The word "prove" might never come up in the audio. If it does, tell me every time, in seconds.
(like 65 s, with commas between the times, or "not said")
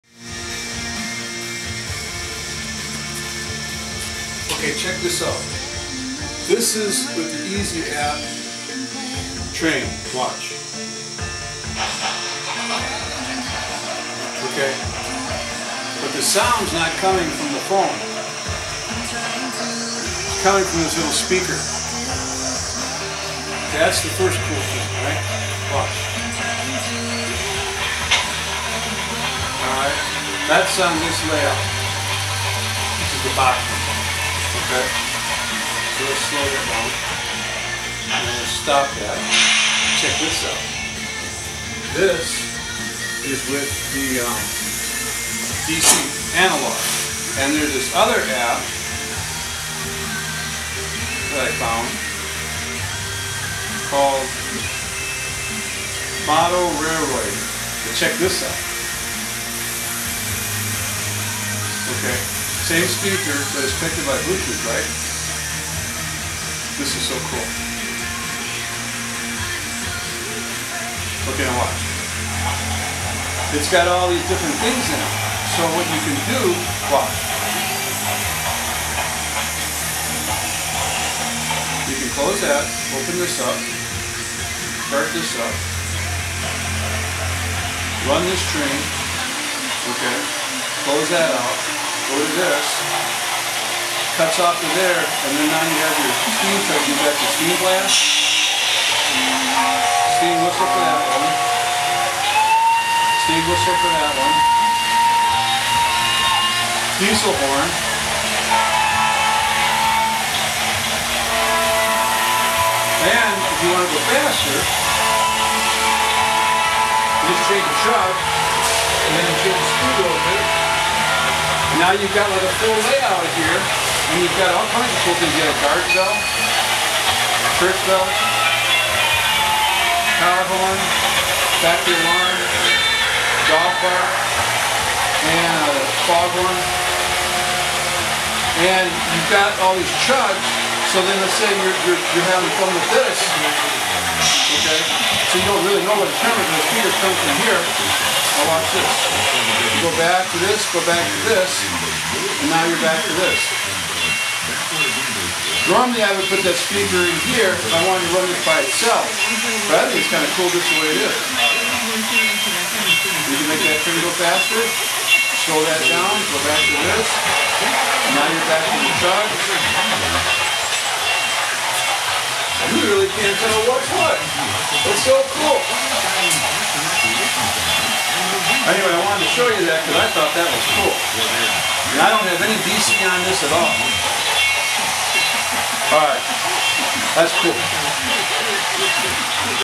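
not said.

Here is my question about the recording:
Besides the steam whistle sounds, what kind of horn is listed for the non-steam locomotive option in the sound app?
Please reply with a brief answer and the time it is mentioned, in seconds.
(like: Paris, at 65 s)
diesel horn, at 106 s.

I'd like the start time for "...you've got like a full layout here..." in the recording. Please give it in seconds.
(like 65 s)
121 s.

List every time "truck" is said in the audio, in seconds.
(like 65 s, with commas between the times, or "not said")
117 s, 168 s.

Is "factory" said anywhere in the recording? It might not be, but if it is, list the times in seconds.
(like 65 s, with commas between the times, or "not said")
131 s.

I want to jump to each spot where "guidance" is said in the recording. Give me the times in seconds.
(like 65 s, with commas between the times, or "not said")
not said.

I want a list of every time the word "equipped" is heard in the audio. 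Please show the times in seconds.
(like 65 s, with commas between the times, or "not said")
not said.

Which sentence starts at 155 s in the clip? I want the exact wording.
Normally I would put that speaker in here if I wanted to run this by itself.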